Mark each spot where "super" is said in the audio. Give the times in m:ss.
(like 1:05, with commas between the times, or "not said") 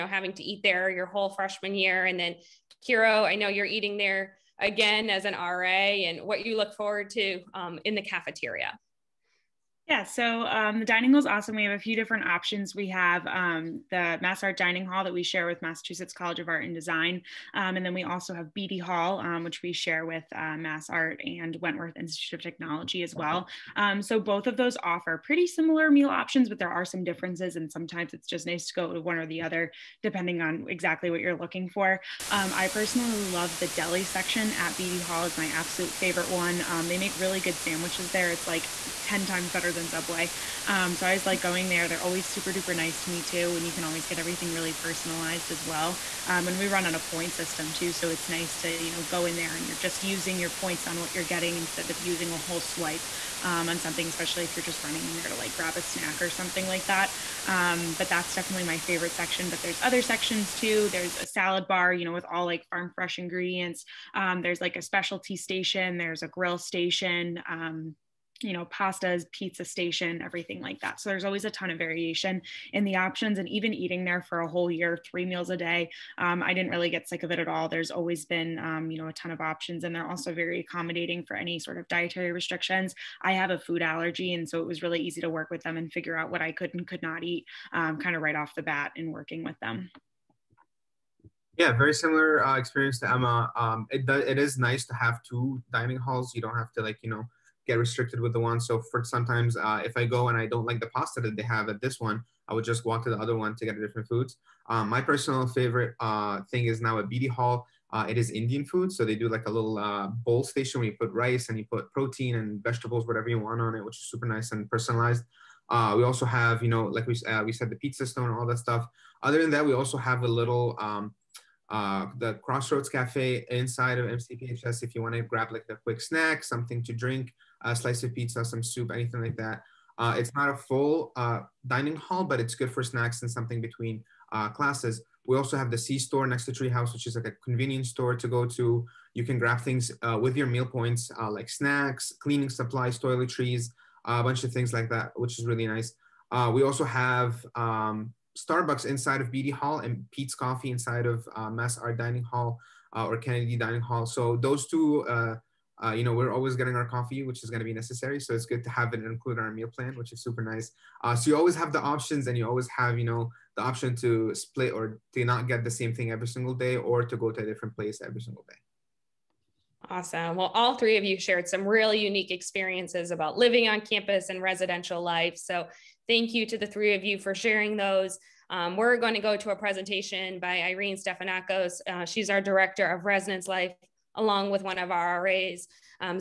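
0:42, 1:54, 2:40.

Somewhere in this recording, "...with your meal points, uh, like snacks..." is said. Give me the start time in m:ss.
2:20.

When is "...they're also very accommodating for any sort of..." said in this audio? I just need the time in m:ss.
1:19.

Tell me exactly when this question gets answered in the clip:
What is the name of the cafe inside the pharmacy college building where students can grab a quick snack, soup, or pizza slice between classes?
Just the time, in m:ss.
2:02.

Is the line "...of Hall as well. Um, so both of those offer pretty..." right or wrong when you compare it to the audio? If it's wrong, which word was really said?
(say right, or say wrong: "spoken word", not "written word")
wrong: "Technology", not "Hall".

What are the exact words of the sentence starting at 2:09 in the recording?
Uh, it's not a full uh, dining hall, but it's good for snacks and something between uh, classes.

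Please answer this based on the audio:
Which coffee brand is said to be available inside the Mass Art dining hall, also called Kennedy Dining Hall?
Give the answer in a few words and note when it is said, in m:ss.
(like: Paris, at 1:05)
Peet's Coffee, at 2:30.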